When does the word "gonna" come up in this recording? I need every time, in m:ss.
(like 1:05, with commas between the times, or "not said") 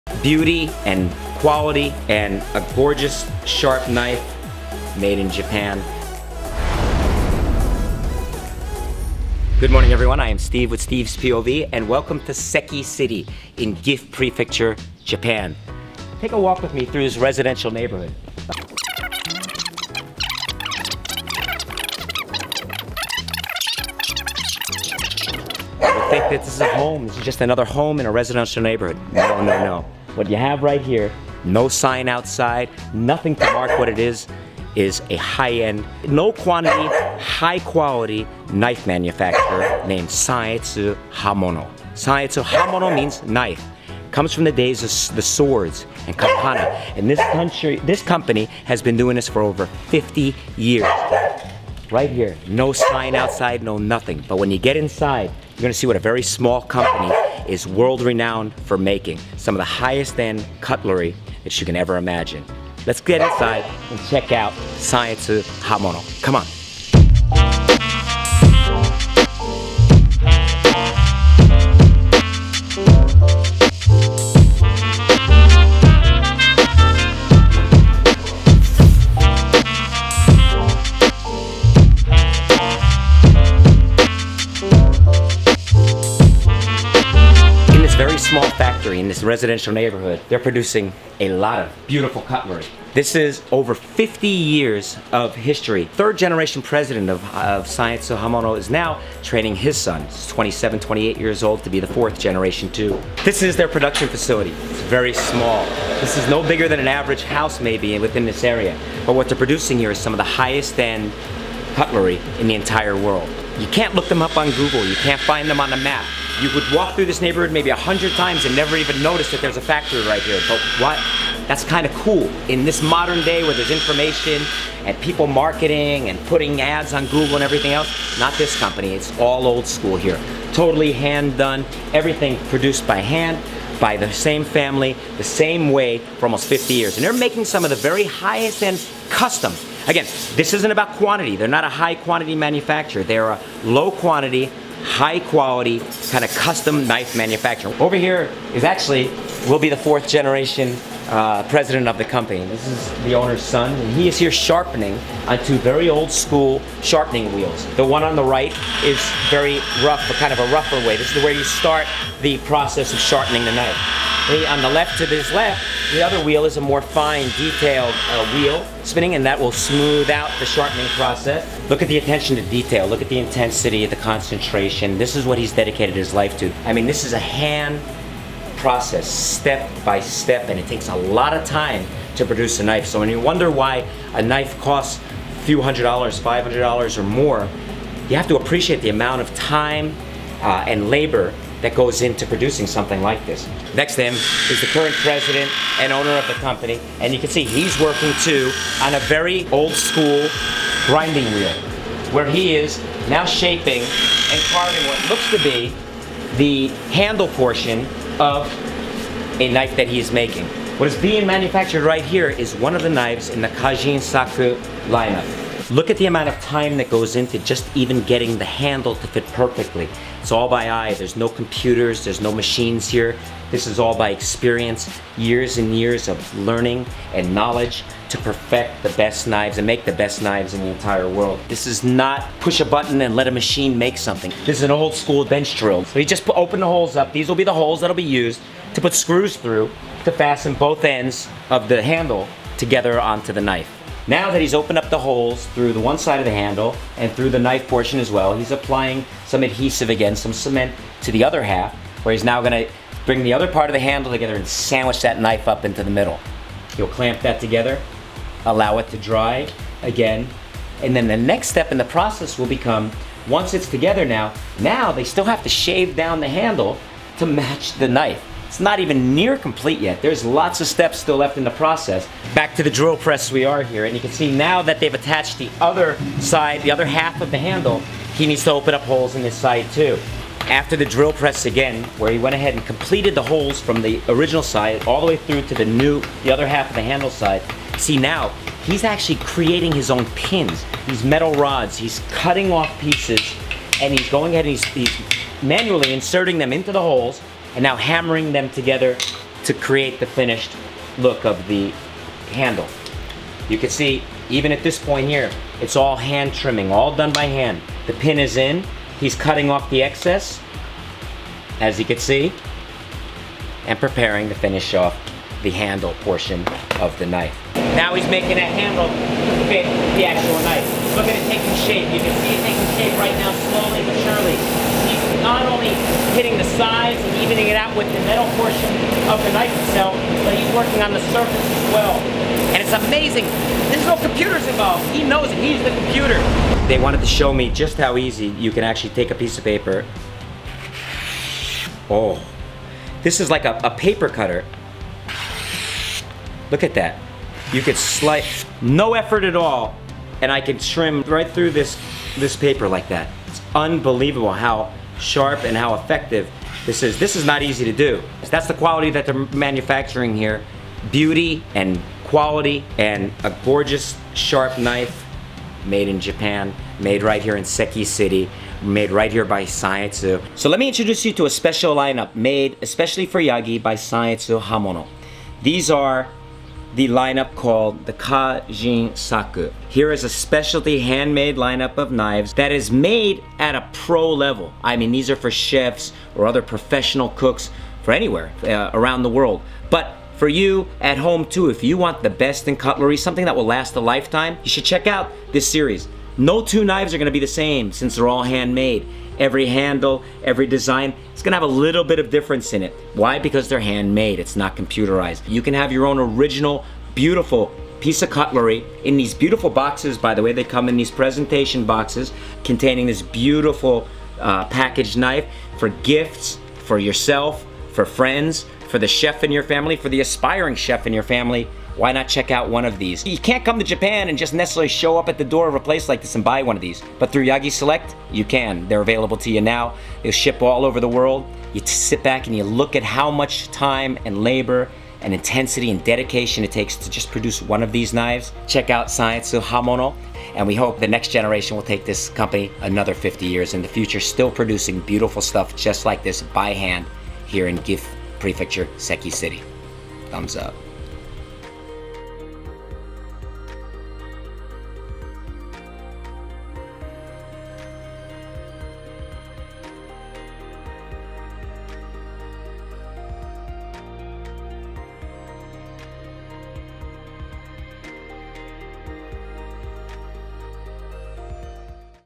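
0:55, 4:12, 6:36, 6:41.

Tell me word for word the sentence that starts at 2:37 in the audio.
The one on the right is very rough, but kind of a rougher way.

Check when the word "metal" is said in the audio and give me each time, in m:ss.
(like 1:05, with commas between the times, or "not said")
4:51, 5:28.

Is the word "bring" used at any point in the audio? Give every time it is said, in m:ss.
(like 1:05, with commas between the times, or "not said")
4:13.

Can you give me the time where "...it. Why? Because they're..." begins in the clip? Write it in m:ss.
6:42.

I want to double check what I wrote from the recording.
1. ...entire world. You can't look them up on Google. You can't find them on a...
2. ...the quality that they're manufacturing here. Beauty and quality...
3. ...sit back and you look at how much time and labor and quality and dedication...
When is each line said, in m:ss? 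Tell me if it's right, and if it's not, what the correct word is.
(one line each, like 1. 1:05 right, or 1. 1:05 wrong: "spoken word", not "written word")
1. 1:52 right
2. 5:58 right
3. 7:11 wrong: "intensity", not "quality".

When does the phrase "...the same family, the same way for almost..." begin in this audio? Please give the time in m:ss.
2:13.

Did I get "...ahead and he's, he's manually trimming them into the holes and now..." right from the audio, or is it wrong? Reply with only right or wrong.
wrong.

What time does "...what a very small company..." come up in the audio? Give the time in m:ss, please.
0:55.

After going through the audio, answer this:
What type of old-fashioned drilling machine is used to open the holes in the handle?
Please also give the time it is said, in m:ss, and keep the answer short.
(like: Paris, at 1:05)
Bench drill, at 3:55.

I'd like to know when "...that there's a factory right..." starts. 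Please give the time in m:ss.
1:59.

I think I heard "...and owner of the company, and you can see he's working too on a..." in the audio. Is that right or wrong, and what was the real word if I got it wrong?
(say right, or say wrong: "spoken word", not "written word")
right.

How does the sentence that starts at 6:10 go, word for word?
So let me introduce you to a special lineup made especially for Yagi by Sannetsu Hamono.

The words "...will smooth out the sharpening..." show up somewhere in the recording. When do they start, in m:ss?
2:49.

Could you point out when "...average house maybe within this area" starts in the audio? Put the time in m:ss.
1:46.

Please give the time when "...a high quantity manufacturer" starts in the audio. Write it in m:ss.
2:21.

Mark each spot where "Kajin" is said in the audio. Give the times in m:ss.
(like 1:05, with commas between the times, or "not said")
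3:33, 6:17.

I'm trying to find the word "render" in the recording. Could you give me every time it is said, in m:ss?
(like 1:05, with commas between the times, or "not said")
not said.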